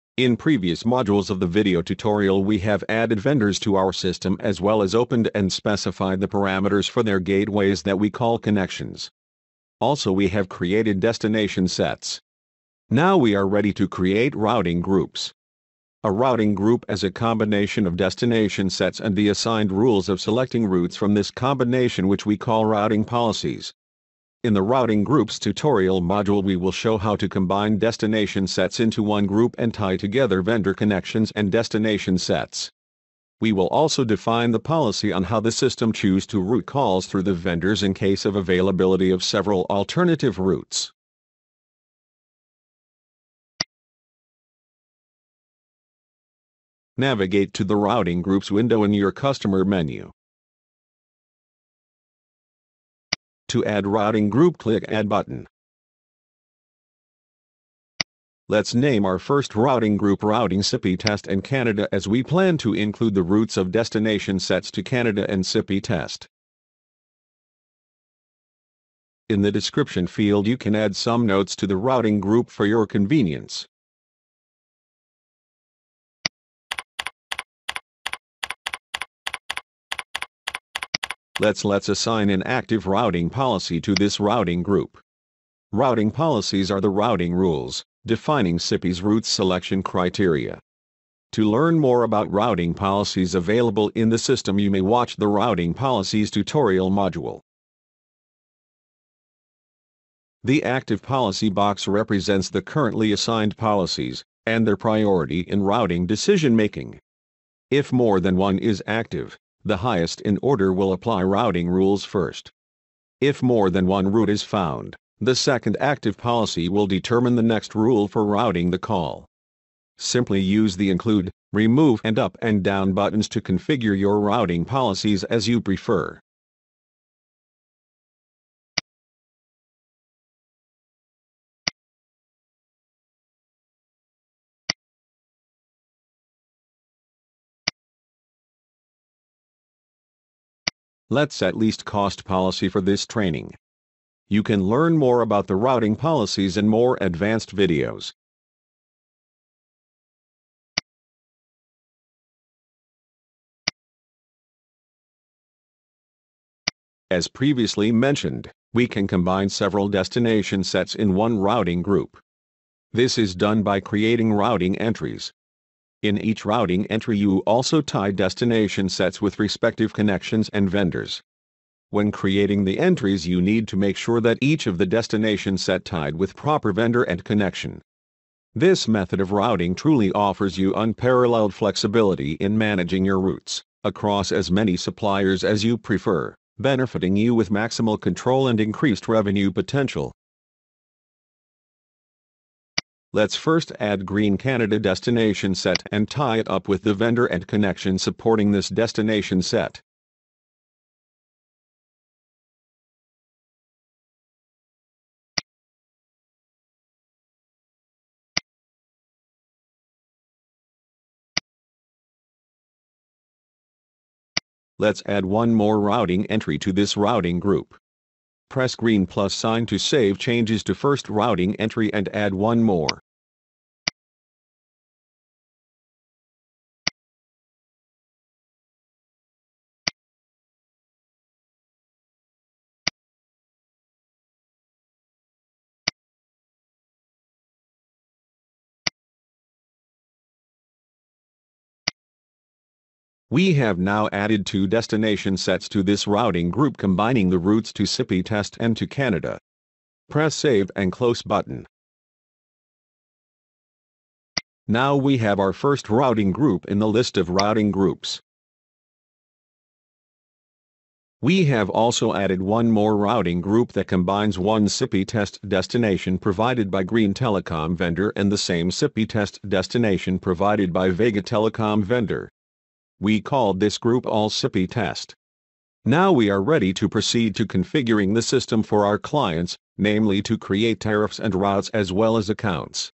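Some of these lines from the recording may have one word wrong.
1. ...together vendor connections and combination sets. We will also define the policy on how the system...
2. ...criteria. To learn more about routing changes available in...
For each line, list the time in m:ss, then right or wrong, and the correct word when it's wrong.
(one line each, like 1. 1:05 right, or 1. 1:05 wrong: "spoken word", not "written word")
1. 0:29 wrong: "destination", not "combination"
2. 1:29 wrong: "policies", not "changes".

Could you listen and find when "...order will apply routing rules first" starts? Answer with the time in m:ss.
1:50.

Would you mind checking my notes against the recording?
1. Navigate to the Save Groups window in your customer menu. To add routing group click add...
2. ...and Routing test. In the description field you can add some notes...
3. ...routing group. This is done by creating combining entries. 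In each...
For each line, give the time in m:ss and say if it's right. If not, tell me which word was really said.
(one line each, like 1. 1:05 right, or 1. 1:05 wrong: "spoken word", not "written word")
1. 0:46 wrong: "Routing", not "Save"
2. 1:05 wrong: "Sippy", not "Routing"
3. 2:41 wrong: "routing", not "combining".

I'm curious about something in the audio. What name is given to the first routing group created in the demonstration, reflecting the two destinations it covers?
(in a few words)
Sippy test and Canada.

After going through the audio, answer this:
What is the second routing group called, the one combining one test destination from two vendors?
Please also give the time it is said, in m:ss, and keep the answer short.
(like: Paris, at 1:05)
All Sippy test, at 4:34.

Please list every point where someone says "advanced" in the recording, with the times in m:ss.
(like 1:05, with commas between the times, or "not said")
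2:27.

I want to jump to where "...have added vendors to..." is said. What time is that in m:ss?
0:02.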